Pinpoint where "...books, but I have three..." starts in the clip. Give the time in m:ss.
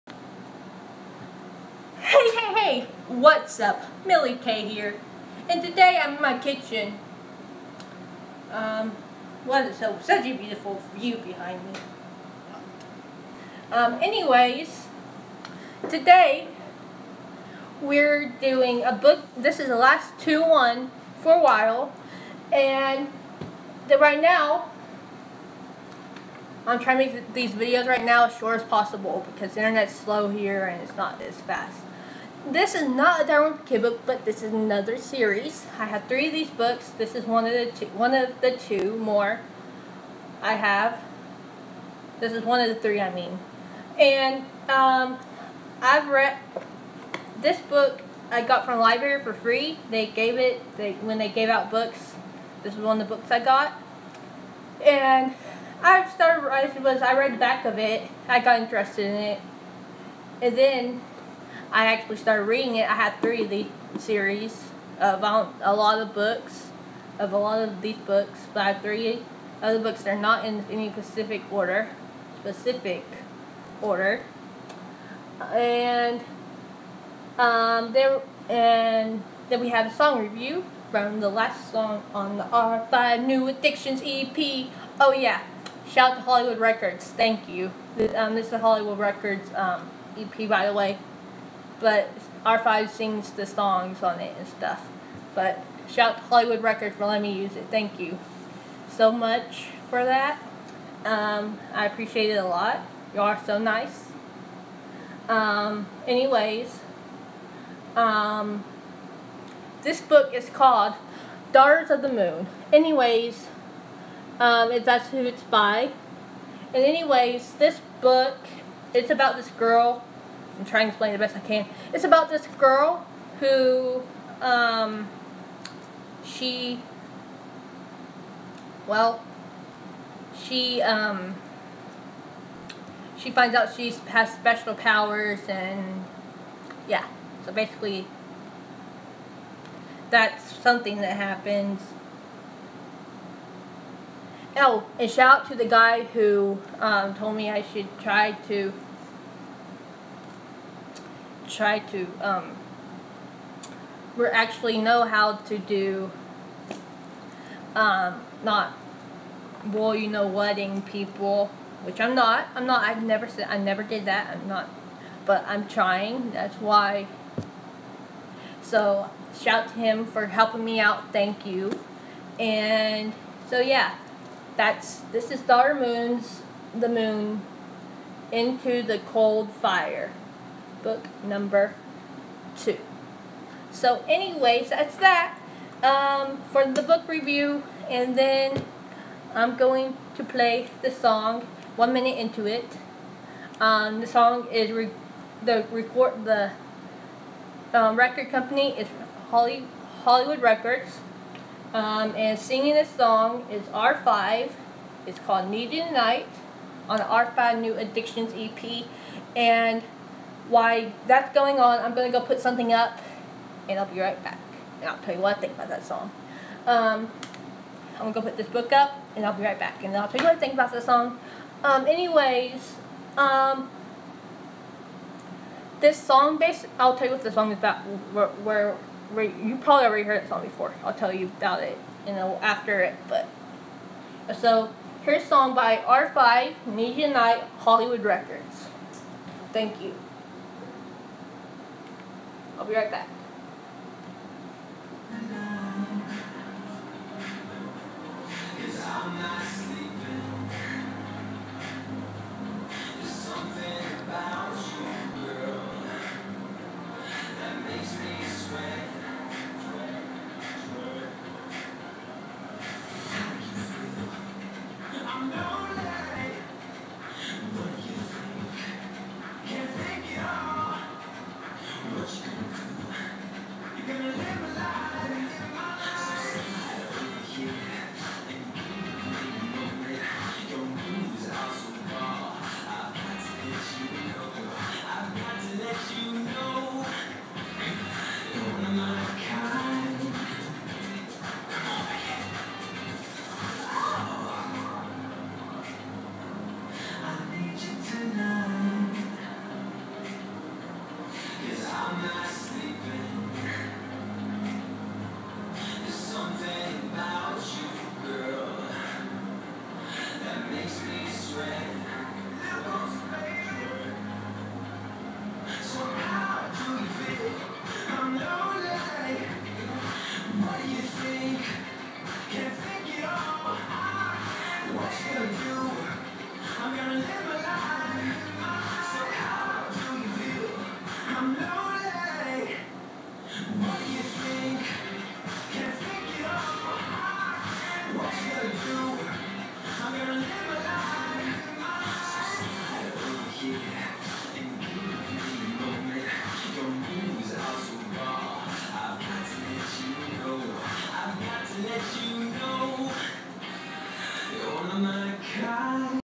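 1:07.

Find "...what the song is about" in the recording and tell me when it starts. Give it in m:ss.
3:47.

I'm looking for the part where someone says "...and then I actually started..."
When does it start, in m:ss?
1:00.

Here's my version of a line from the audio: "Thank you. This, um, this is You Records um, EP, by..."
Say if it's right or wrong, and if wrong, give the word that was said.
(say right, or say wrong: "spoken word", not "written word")
wrong: "Hollywood", not "You".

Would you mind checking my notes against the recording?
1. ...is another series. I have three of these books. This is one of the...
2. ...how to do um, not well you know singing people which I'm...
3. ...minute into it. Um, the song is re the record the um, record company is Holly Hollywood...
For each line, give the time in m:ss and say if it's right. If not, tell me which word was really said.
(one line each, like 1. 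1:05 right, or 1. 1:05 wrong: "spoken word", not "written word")
1. 0:34 right
2. 2:35 wrong: "wedding", not "singing"
3. 3:11 right.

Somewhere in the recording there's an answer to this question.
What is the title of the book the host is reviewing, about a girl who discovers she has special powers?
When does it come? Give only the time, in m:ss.
1:51.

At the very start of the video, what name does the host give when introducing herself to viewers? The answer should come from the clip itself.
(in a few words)
Millie K.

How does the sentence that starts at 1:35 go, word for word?
But shout to Hollywood Records for letting me use it.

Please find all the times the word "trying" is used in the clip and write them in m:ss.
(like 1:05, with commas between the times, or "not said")
0:26, 2:00, 2:45.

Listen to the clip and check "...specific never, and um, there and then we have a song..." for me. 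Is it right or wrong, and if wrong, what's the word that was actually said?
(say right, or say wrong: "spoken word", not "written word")
wrong: "order", not "never".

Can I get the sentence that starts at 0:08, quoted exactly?
Um, what is so such a beautiful view behind me.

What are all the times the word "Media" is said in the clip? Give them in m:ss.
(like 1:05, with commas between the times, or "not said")
3:56.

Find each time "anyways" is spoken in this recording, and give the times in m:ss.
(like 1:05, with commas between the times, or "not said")
0:14, 1:46, 1:52, 1:56, 3:04, 3:41.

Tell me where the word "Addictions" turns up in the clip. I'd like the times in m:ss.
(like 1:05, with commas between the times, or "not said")
1:23, 3:27.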